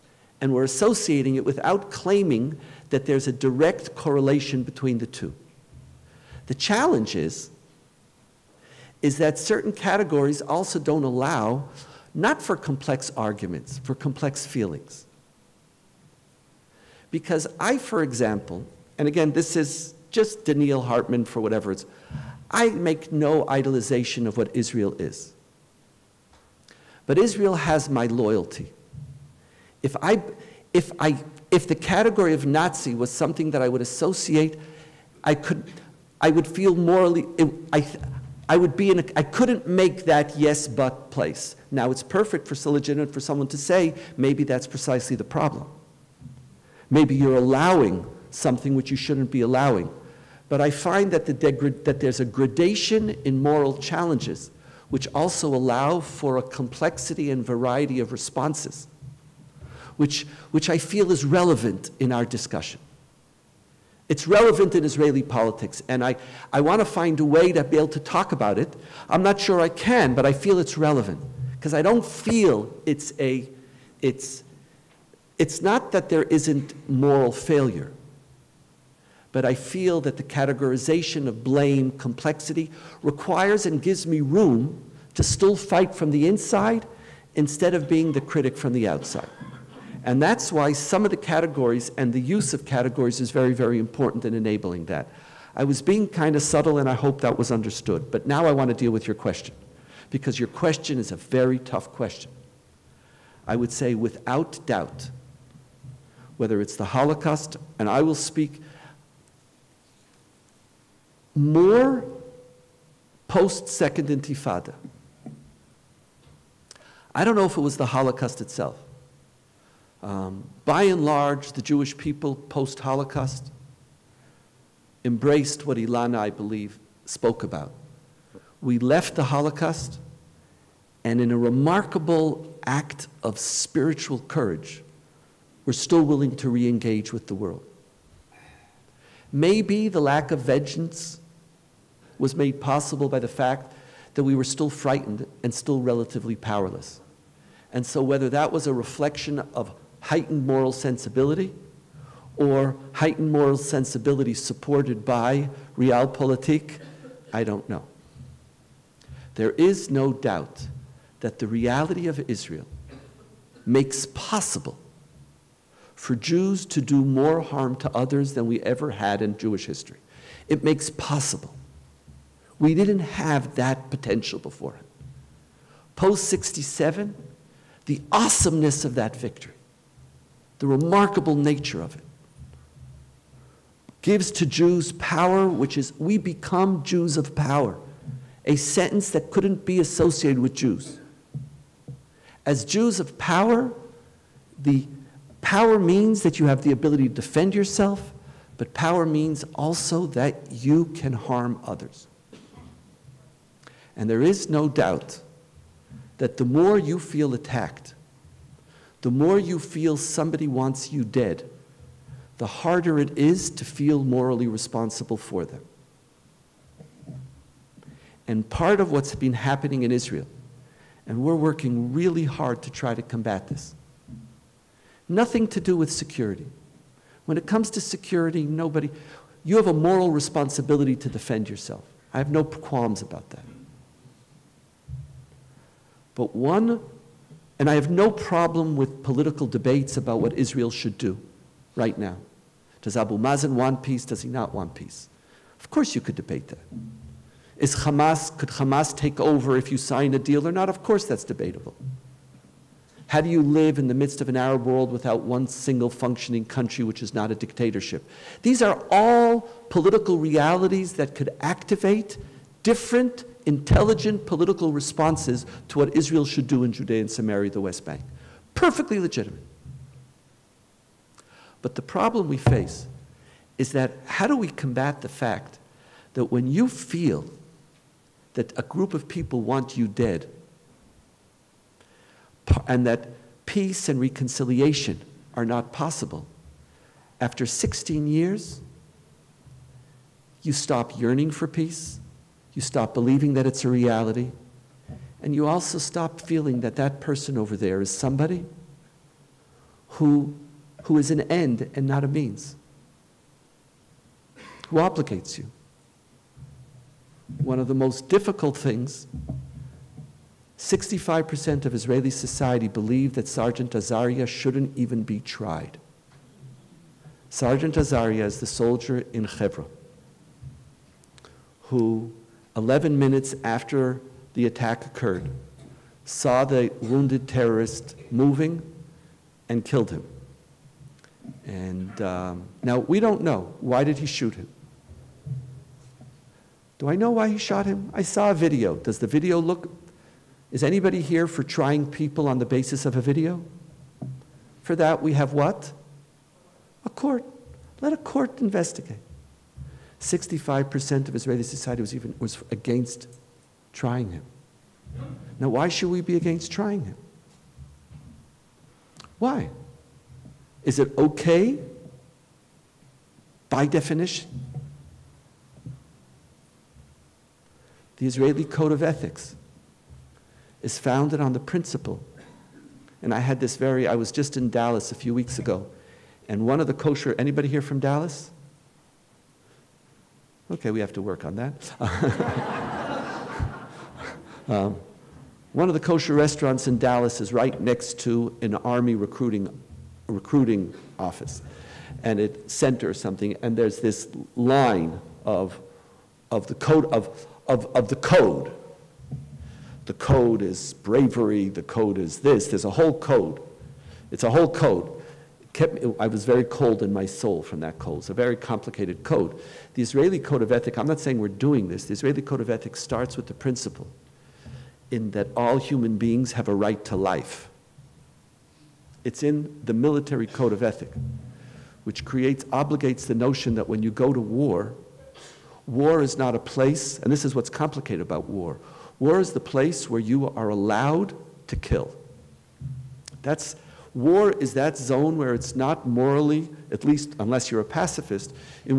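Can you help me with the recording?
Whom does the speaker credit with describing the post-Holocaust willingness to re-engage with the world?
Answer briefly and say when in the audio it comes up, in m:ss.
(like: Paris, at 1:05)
Ilana, at 2:05.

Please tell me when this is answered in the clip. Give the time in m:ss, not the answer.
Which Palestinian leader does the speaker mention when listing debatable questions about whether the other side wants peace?
4:02.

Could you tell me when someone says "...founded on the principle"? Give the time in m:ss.
6:10.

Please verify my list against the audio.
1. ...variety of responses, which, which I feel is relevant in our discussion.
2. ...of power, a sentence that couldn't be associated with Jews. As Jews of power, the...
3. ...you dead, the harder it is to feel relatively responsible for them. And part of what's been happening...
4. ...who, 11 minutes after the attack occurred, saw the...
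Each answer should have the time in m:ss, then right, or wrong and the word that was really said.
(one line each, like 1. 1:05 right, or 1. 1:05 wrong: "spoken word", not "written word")
1. 0:57 right
2. 3:07 right
3. 3:30 wrong: "morally", not "relatively"
4. 5:21 right.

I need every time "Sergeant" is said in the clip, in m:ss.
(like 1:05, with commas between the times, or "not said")
5:13, 5:17.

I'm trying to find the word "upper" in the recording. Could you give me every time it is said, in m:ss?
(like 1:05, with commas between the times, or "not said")
not said.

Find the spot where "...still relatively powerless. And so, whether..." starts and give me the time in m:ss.
2:25.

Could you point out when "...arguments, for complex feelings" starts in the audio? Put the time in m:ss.
0:13.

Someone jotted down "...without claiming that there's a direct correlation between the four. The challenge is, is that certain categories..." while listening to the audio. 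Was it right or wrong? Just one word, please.
wrong.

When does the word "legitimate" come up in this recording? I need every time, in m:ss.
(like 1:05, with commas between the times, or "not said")
0:42, 4:28.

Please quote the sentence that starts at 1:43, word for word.
I would say without doubt, whether it's the Holocaust, and I will speak more post-Second Intifada.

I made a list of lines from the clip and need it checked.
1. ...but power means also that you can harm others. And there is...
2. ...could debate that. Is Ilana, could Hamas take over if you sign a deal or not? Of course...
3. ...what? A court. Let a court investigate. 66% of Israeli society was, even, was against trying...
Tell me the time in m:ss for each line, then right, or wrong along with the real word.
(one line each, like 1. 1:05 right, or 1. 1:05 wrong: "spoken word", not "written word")
1. 3:18 right
2. 4:06 wrong: "Hamas", not "Ilana"
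3. 5:45 wrong: "65", not "66".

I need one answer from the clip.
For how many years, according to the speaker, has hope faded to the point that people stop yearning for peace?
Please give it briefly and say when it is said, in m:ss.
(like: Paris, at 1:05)
16, at 4:47.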